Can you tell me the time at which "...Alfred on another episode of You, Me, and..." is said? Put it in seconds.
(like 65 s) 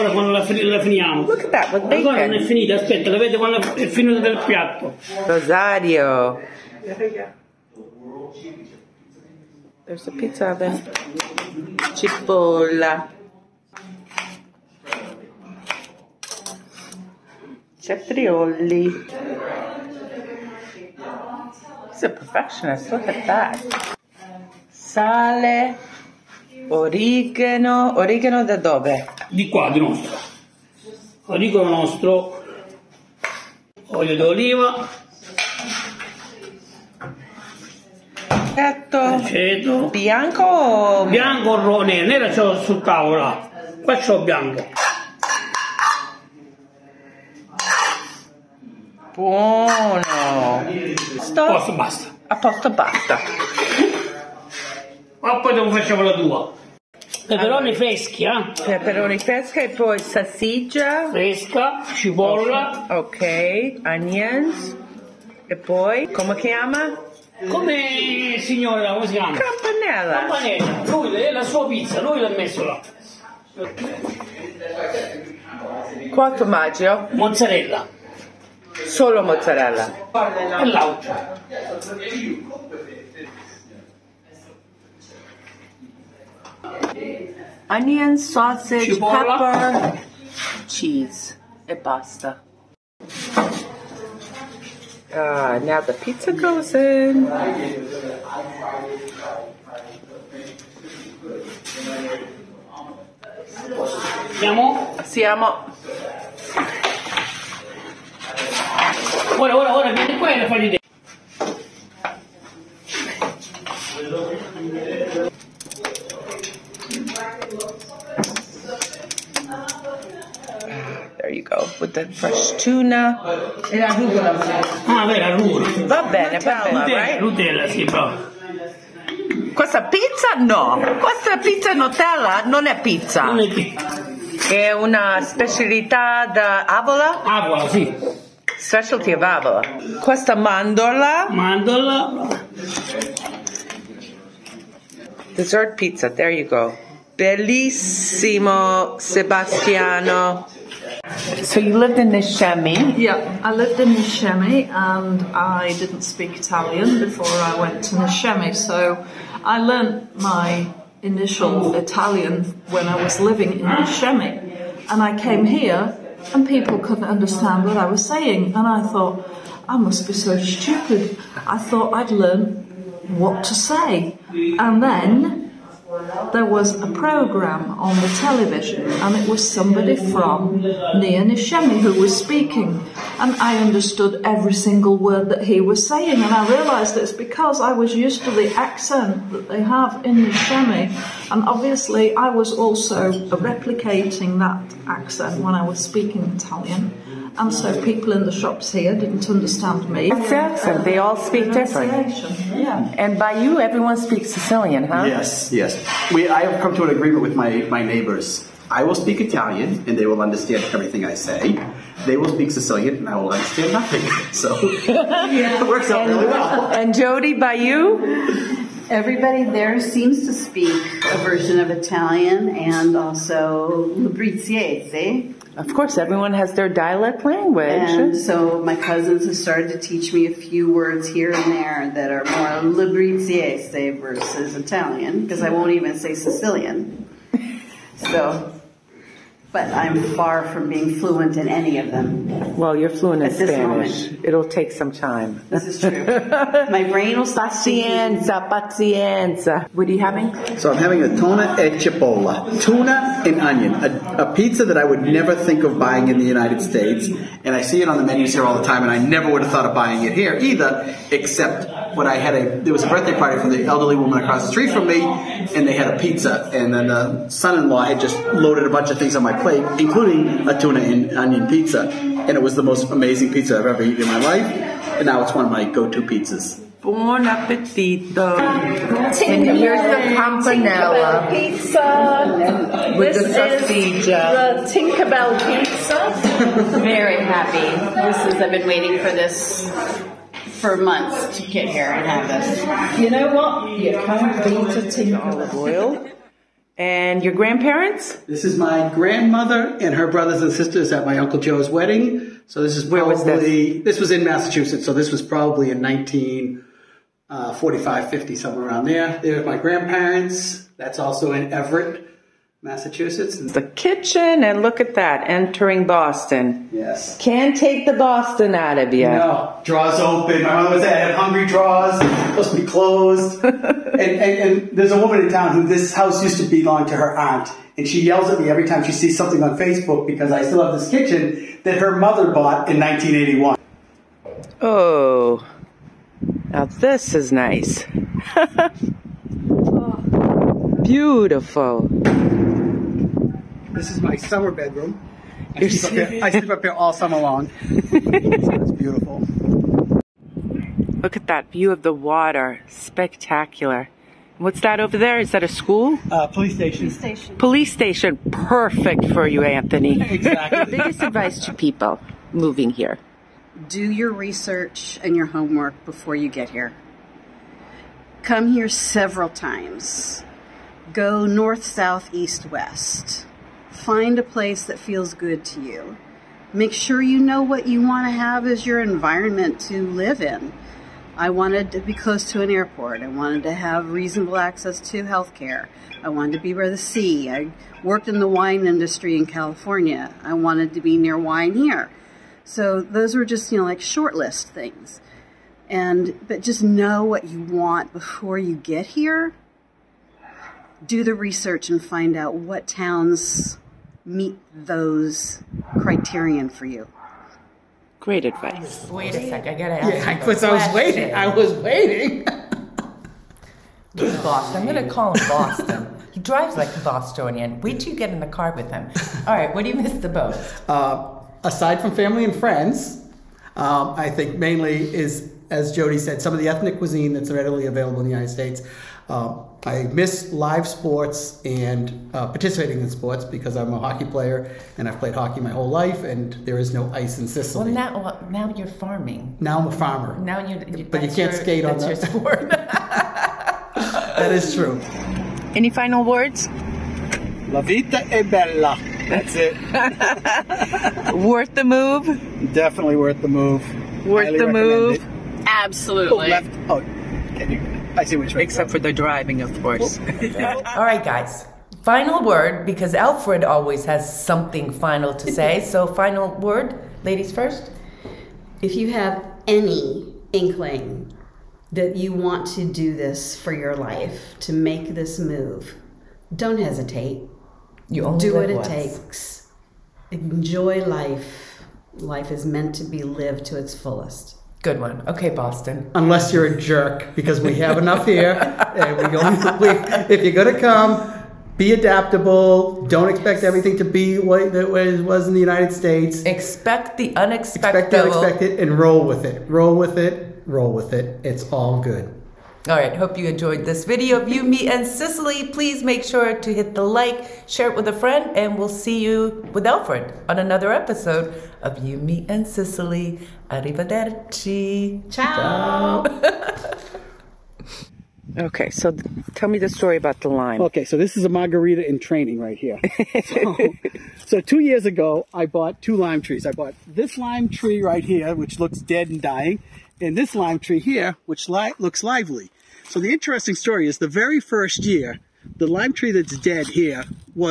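509 s.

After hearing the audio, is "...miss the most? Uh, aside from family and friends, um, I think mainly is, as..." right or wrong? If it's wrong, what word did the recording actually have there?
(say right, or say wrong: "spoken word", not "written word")
right.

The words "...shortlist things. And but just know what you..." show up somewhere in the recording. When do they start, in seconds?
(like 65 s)
393 s.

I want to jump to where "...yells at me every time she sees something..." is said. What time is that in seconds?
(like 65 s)
328 s.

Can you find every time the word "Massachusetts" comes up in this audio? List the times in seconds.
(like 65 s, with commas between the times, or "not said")
304 s, 312 s.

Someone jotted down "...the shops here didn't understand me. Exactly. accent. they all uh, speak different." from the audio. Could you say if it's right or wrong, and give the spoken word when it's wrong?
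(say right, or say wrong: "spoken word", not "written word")
right.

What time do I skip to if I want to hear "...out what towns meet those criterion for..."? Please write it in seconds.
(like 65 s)
402 s.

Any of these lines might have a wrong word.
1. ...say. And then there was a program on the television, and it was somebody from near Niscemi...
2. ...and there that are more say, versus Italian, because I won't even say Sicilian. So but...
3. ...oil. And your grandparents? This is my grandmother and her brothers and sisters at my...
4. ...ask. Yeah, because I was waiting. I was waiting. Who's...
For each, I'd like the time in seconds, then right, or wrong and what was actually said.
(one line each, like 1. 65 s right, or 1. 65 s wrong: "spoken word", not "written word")
1. 173 s right
2. 231 s right
3. 295 s right
4. 409 s right.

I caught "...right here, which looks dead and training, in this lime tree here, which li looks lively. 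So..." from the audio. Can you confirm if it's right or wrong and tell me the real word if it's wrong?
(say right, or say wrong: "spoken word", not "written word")
wrong: "dying", not "training".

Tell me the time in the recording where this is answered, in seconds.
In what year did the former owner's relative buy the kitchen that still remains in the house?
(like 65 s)
332 s.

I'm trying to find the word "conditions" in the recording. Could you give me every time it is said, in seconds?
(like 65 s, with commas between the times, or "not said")
not said.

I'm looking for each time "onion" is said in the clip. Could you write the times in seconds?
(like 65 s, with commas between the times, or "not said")
63 s, 87 s, 253 s, 271 s.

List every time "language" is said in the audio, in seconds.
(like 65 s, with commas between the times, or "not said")
227 s.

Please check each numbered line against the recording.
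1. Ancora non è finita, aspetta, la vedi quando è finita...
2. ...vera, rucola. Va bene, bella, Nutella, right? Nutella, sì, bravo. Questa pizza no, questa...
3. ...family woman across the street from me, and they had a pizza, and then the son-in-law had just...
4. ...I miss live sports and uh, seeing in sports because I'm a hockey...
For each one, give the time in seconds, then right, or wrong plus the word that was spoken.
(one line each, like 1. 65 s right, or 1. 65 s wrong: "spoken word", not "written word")
1. 2 s right
2. 125 s right
3. 263 s wrong: "elderly", not "family"
4. 429 s wrong: "participating", not "seeing".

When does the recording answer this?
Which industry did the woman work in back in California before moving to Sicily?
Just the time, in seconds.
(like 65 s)
388 s.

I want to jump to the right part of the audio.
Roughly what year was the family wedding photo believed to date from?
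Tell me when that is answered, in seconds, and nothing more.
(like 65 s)
305 s.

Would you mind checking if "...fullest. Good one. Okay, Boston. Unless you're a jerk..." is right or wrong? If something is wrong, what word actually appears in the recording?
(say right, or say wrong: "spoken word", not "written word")
right.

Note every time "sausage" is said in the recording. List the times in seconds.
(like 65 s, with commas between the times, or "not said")
88 s, 283 s.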